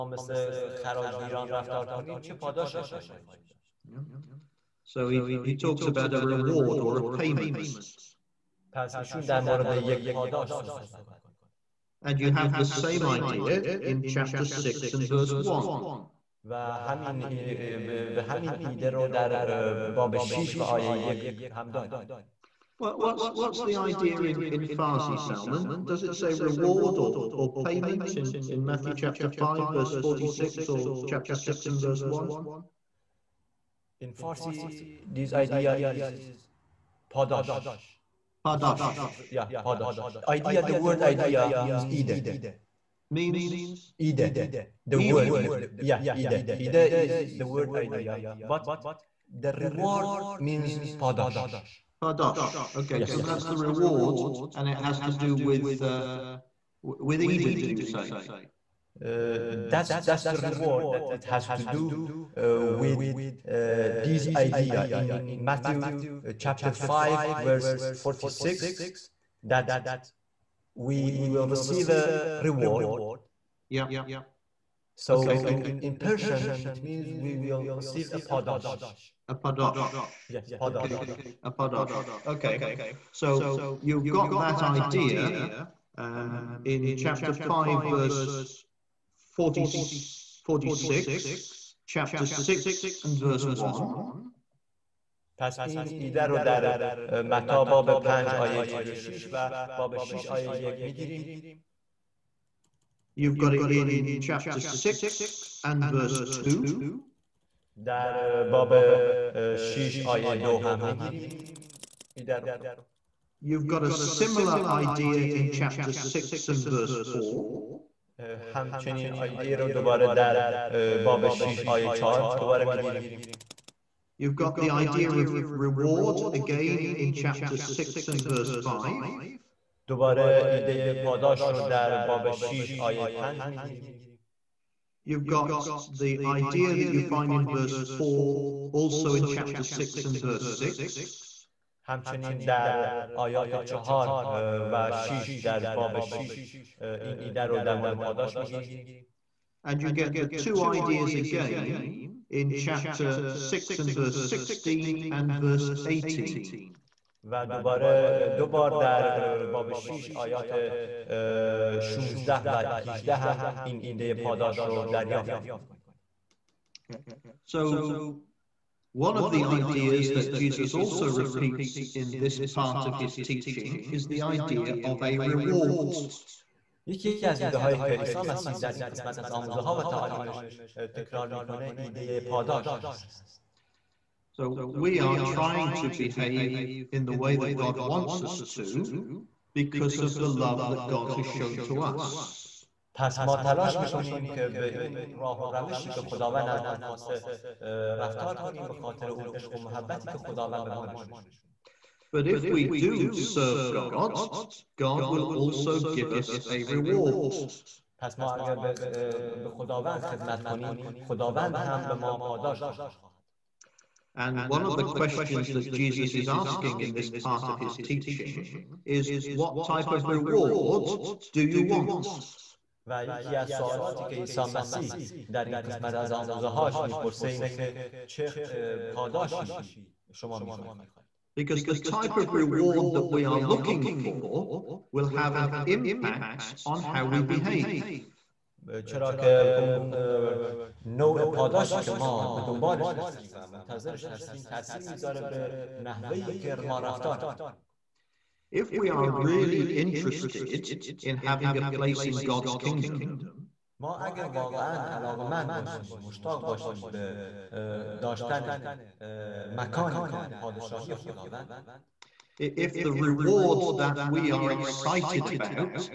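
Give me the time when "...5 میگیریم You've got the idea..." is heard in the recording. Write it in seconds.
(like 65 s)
133 s.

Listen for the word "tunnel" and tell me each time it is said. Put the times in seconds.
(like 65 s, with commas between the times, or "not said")
not said.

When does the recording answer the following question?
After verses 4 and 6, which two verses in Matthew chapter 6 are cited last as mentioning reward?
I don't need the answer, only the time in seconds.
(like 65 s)
153 s.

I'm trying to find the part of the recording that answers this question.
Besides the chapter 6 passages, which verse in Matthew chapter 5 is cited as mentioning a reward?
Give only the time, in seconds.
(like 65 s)
66 s.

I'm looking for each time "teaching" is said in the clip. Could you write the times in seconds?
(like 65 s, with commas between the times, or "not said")
173 s, 217 s.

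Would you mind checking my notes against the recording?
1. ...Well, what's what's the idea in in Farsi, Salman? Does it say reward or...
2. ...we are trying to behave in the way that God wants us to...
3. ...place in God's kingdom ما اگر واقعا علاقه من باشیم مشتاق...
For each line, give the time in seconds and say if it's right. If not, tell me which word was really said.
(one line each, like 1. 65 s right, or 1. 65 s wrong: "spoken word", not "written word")
1. 22 s right
2. 184 s right
3. 251 s right.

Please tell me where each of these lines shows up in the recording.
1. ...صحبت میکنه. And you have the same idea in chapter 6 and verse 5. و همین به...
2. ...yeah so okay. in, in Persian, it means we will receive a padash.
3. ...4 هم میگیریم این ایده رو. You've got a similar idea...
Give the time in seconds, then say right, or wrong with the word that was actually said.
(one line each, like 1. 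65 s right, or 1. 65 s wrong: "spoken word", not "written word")
1. 10 s wrong: "1", not "5"
2. 73 s right
3. 110 s wrong: "2", not "4".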